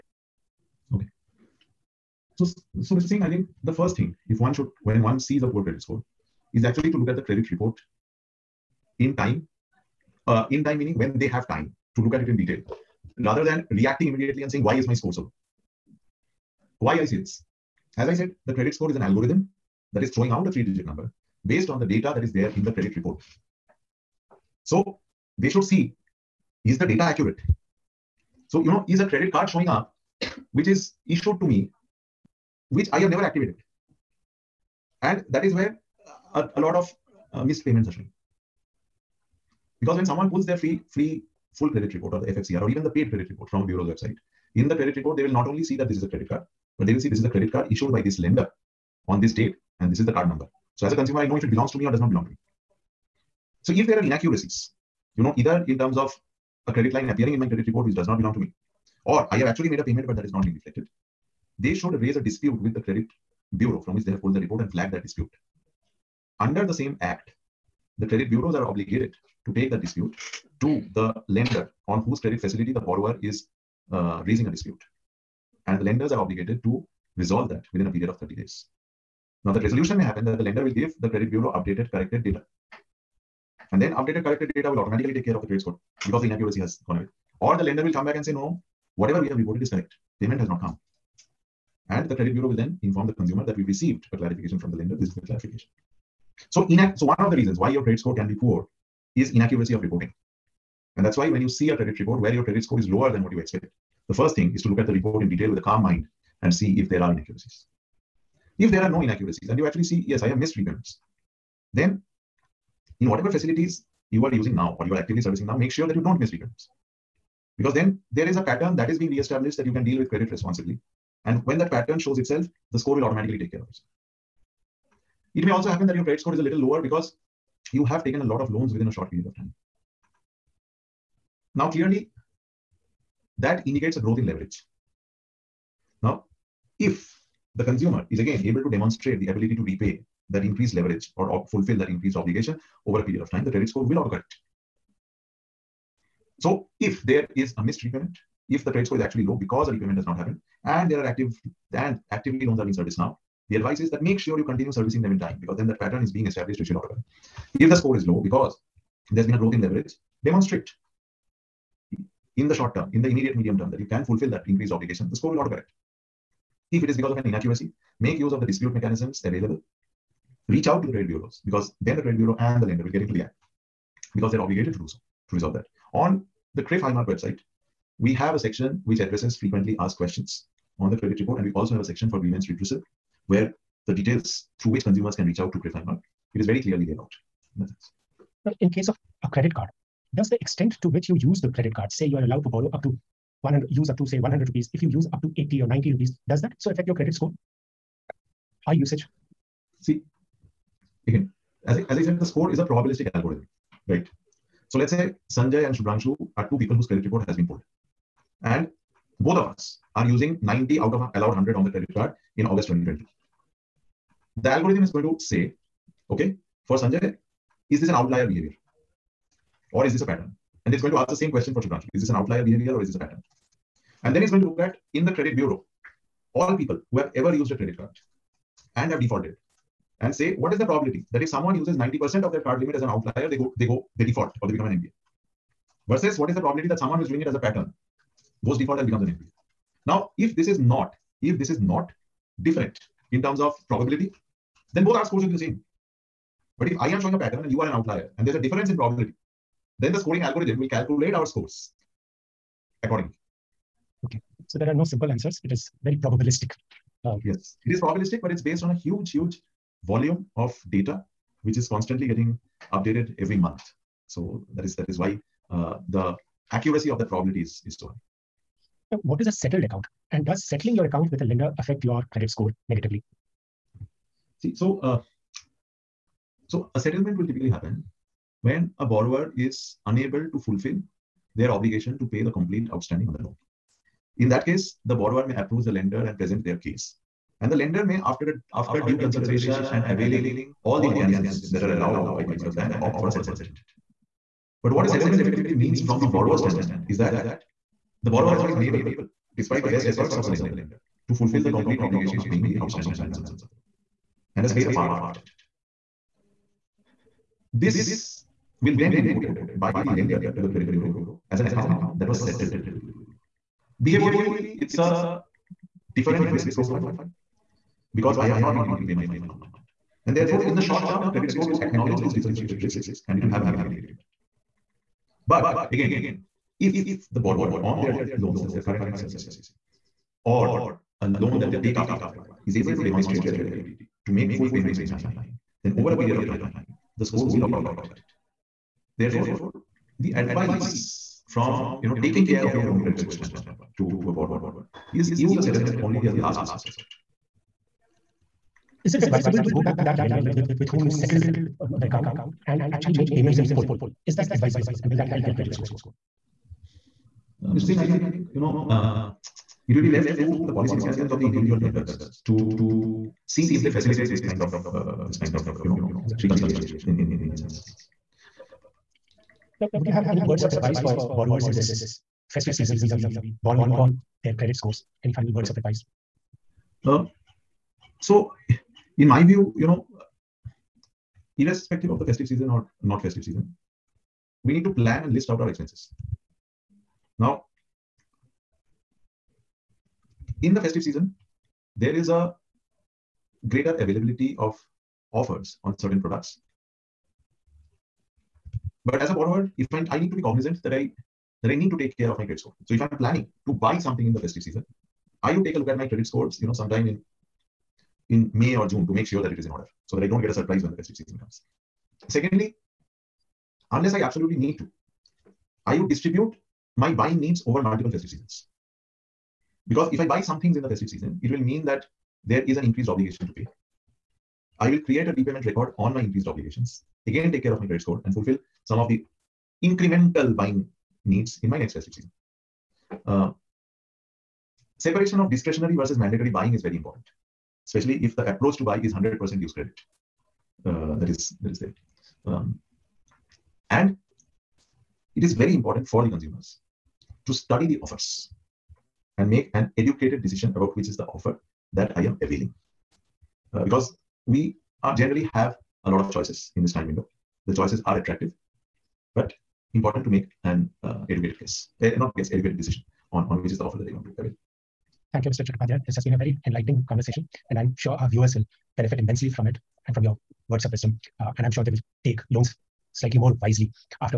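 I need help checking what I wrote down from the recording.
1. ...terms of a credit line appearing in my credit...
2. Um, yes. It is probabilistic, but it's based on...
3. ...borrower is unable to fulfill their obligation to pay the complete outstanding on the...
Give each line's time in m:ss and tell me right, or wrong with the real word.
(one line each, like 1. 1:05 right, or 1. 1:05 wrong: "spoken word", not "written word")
1. 0:55 right
2. 4:17 right
3. 4:38 right.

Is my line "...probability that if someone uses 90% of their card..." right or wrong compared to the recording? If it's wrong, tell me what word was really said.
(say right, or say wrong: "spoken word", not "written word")
right.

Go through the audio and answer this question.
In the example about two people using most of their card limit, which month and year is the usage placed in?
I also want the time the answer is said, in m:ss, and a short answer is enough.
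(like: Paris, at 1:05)
August 2020, at 3:32.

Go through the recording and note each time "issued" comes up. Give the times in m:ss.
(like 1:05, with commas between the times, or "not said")
0:31, 0:47.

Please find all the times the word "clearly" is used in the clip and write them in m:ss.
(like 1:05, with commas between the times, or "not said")
2:11, 3:06.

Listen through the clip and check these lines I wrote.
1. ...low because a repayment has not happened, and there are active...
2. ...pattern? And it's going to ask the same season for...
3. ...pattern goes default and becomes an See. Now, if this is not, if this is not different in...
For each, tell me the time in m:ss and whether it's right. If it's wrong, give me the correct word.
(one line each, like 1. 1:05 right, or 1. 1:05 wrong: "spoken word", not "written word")
1. 2:29 right
2. 3:40 wrong: "question", not "season"
3. 3:57 wrong: "NPA", not "See".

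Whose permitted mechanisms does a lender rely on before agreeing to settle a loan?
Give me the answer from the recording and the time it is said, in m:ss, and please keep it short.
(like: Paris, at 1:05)
Reserve Bank, at 4:52.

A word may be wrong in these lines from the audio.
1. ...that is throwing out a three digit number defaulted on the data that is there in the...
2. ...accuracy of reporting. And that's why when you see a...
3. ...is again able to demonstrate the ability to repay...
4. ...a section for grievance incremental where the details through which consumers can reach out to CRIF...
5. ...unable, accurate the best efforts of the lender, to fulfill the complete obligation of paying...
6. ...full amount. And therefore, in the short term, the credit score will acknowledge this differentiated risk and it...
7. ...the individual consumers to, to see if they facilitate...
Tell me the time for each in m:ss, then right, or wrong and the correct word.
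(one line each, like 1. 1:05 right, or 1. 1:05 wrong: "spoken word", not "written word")
1. 0:19 wrong: "based", not "defaulted"
2. 1:39 wrong: "inaccuracy", not "accuracy"
3. 2:18 right
4. 3:01 wrong: "redressal", not "incremental"
5. 4:58 wrong: "despite", not "accurate"
6. 5:19 right
7. 6:01 wrong: "lenders", not "consumers".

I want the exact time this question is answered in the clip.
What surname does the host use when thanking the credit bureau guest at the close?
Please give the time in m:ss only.
7:45.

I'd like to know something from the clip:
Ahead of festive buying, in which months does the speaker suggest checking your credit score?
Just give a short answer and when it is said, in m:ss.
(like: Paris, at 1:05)
May or June, at 6:48.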